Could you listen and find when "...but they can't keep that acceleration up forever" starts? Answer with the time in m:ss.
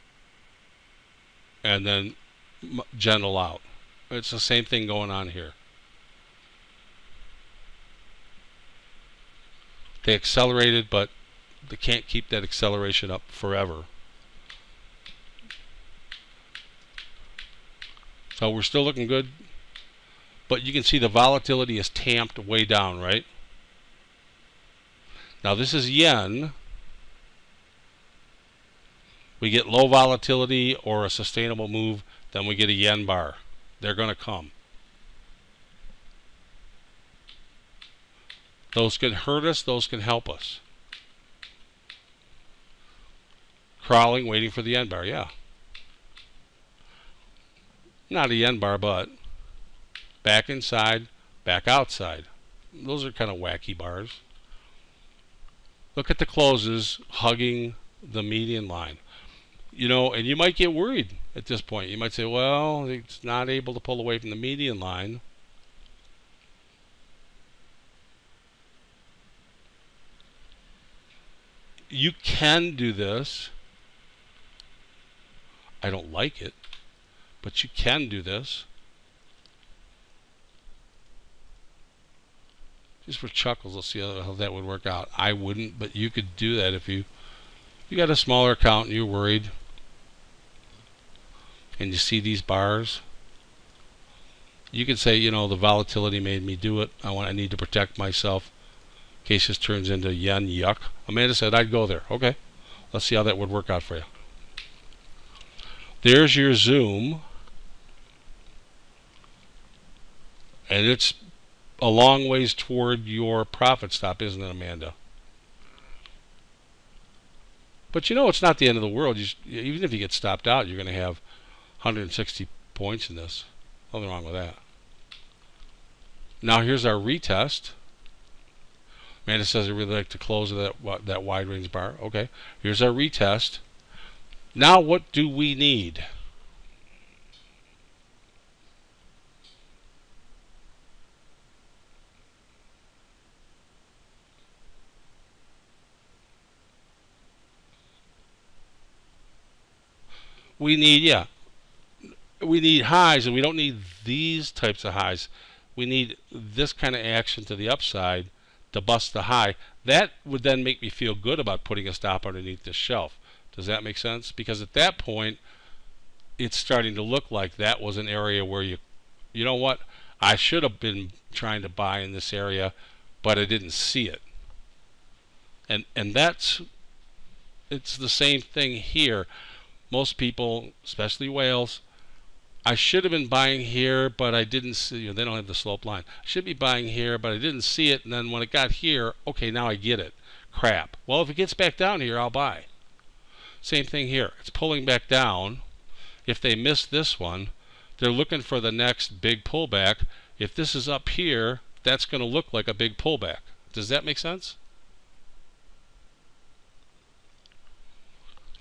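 0:10.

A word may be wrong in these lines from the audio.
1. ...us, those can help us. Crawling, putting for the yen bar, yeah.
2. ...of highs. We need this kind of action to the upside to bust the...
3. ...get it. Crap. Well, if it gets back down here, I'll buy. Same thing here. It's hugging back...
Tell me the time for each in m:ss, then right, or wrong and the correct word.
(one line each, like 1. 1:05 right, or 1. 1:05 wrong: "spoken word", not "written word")
1. 0:39 wrong: "waiting", not "putting"
2. 2:34 right
3. 3:09 wrong: "pulling", not "hugging".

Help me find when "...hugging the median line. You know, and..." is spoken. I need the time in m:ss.
0:57.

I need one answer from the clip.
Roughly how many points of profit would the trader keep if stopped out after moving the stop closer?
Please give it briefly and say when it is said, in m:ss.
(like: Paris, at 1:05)
160, at 2:01.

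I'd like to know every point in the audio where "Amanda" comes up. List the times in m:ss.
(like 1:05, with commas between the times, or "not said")
1:41, 1:54, 2:09.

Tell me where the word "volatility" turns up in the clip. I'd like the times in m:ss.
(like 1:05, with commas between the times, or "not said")
0:21, 0:29, 1:35.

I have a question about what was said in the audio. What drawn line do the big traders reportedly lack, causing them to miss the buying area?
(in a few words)
slope line.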